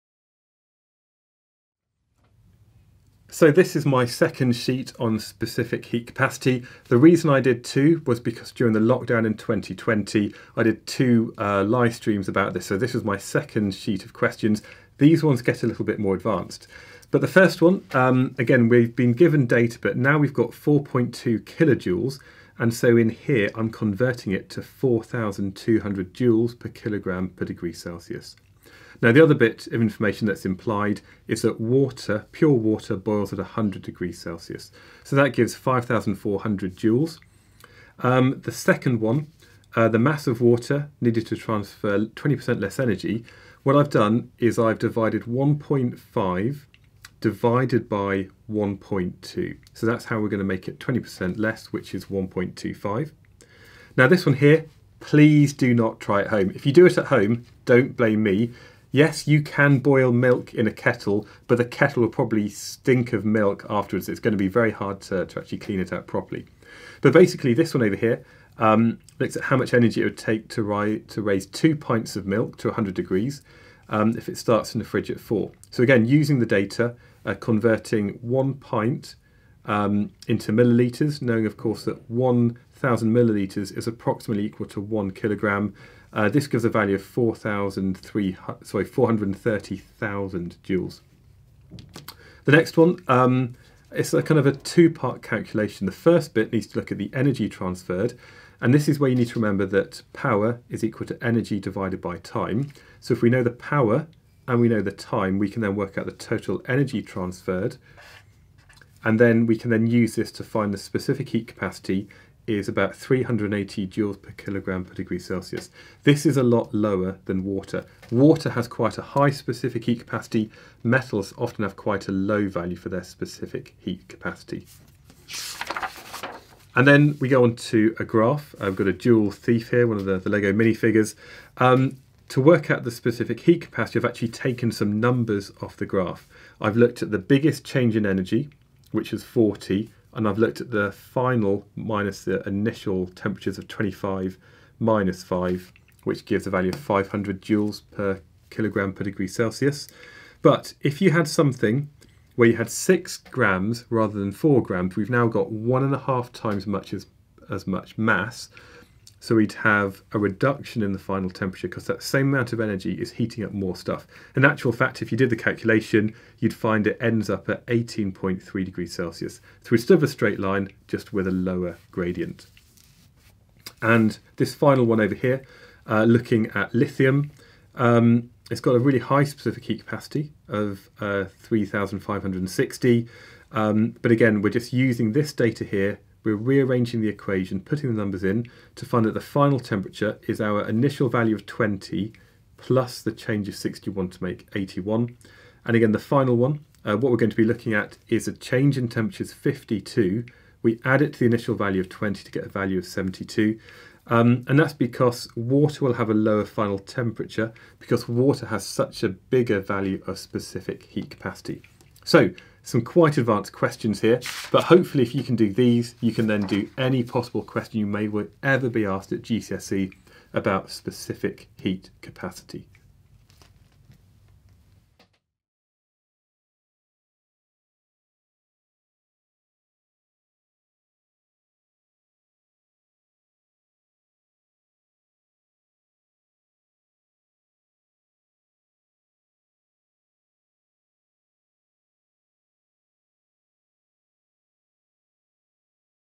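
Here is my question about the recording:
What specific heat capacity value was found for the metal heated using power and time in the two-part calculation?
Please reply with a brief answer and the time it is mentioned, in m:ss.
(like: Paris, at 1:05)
380 J/kg°C, at 1:52.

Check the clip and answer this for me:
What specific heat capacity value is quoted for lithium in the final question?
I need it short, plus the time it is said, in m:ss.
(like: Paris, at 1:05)
3,560, at 3:01.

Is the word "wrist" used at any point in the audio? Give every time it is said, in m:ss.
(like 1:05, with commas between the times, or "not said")
not said.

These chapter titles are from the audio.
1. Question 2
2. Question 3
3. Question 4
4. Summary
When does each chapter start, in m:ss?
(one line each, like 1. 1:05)
1. 1:31
2. 2:09
3. 2:54
4. 3:31.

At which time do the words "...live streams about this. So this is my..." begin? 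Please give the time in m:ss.
0:11.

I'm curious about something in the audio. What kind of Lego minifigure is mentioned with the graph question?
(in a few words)
Jewel thief.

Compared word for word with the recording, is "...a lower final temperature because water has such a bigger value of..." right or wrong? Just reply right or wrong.
right.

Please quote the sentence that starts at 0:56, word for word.
If you do it at home, don't blame me.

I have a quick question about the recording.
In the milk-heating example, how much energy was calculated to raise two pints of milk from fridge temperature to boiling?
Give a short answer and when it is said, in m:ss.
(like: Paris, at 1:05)
430,000 joules, at 1:28.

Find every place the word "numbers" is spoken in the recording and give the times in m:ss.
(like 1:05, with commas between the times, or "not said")
2:15, 3:07.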